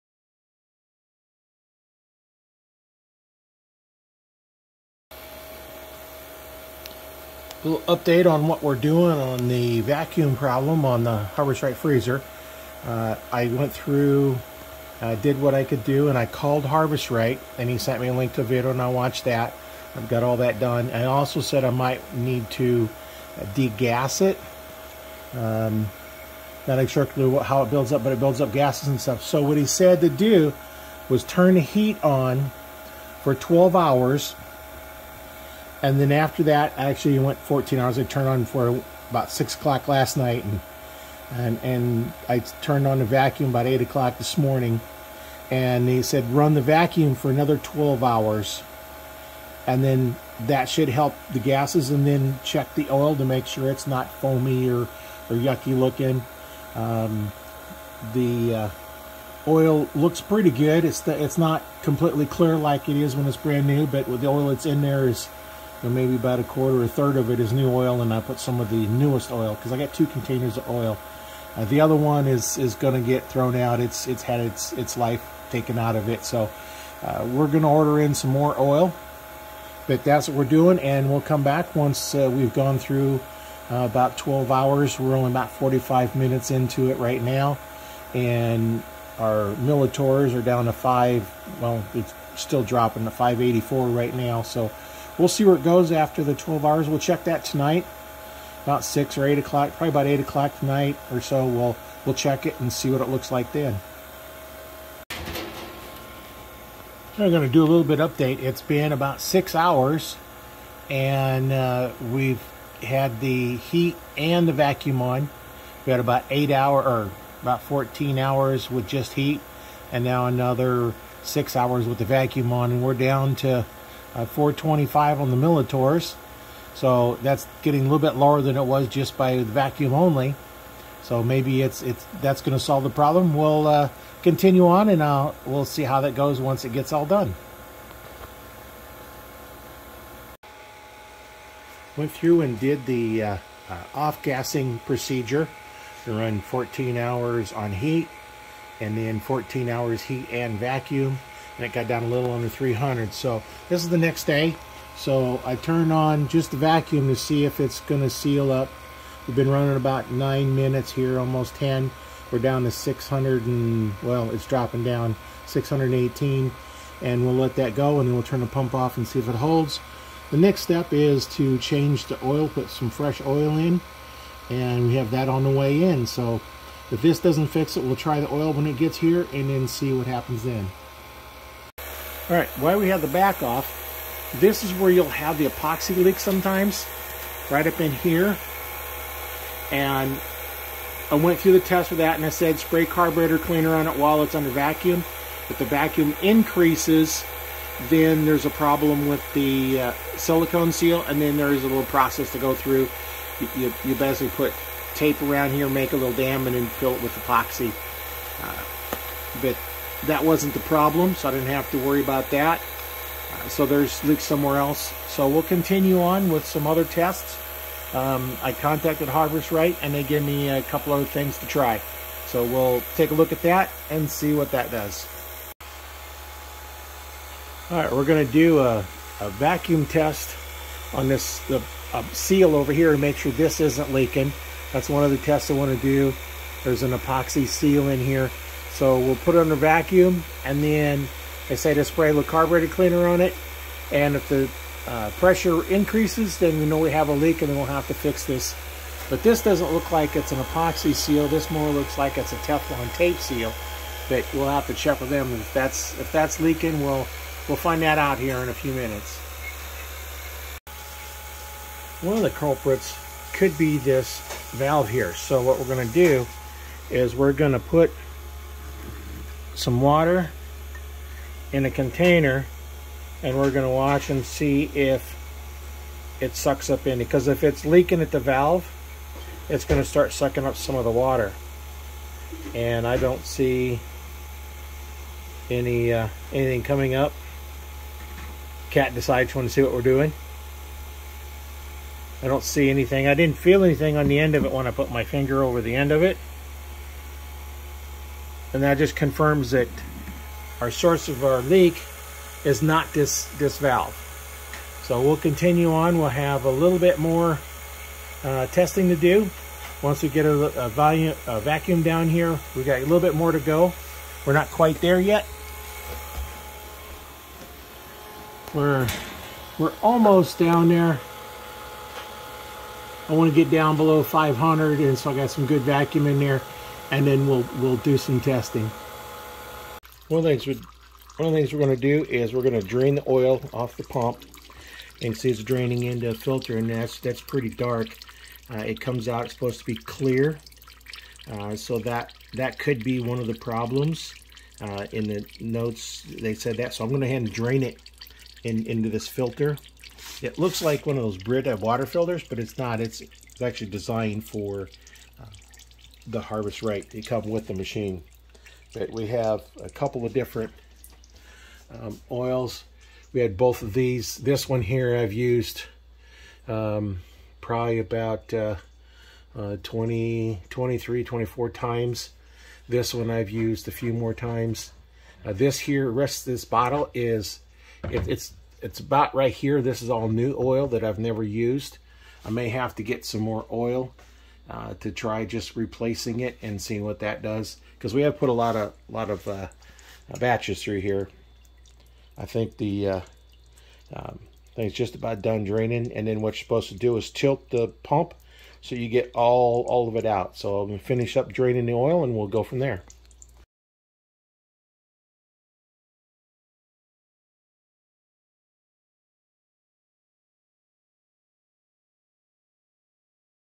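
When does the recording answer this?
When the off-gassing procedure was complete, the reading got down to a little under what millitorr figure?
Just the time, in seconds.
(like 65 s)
152 s.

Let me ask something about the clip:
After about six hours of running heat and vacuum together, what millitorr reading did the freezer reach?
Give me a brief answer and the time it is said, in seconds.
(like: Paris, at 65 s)
425, at 124 s.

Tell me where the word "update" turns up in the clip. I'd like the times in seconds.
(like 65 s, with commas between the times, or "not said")
7 s, 107 s.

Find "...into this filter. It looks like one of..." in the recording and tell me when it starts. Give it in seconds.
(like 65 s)
348 s.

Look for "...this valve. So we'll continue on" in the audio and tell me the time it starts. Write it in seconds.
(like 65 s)
303 s.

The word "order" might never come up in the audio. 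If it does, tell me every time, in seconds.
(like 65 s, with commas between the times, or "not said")
77 s.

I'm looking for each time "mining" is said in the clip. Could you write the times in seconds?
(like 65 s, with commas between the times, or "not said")
not said.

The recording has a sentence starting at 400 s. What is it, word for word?
So I'm gonna finish up draining the oil, and we'll go from there.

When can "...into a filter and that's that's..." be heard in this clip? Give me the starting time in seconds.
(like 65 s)
335 s.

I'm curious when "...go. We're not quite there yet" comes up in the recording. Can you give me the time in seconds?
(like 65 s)
313 s.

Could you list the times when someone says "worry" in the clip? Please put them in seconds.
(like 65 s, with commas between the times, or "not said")
211 s.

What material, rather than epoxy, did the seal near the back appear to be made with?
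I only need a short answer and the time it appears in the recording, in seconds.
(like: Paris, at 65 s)
Teflon tape, at 252 s.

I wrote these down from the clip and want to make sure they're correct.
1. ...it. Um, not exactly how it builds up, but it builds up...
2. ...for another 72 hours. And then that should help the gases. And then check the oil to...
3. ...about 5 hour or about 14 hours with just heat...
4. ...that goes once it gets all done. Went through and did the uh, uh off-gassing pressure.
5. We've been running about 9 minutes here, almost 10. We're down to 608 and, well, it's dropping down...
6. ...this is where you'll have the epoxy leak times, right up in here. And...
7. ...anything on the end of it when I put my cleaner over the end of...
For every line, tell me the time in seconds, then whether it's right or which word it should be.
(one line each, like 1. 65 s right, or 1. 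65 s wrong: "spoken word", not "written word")
1. 24 s right
2. 47 s wrong: "12", not "72"
3. 115 s wrong: "8", not "5"
4. 136 s wrong: "procedure", not "pressure"
5. 159 s wrong: "600", not "608"
6. 184 s wrong: "sometimes", not "times"
7. 293 s wrong: "finger", not "cleaner".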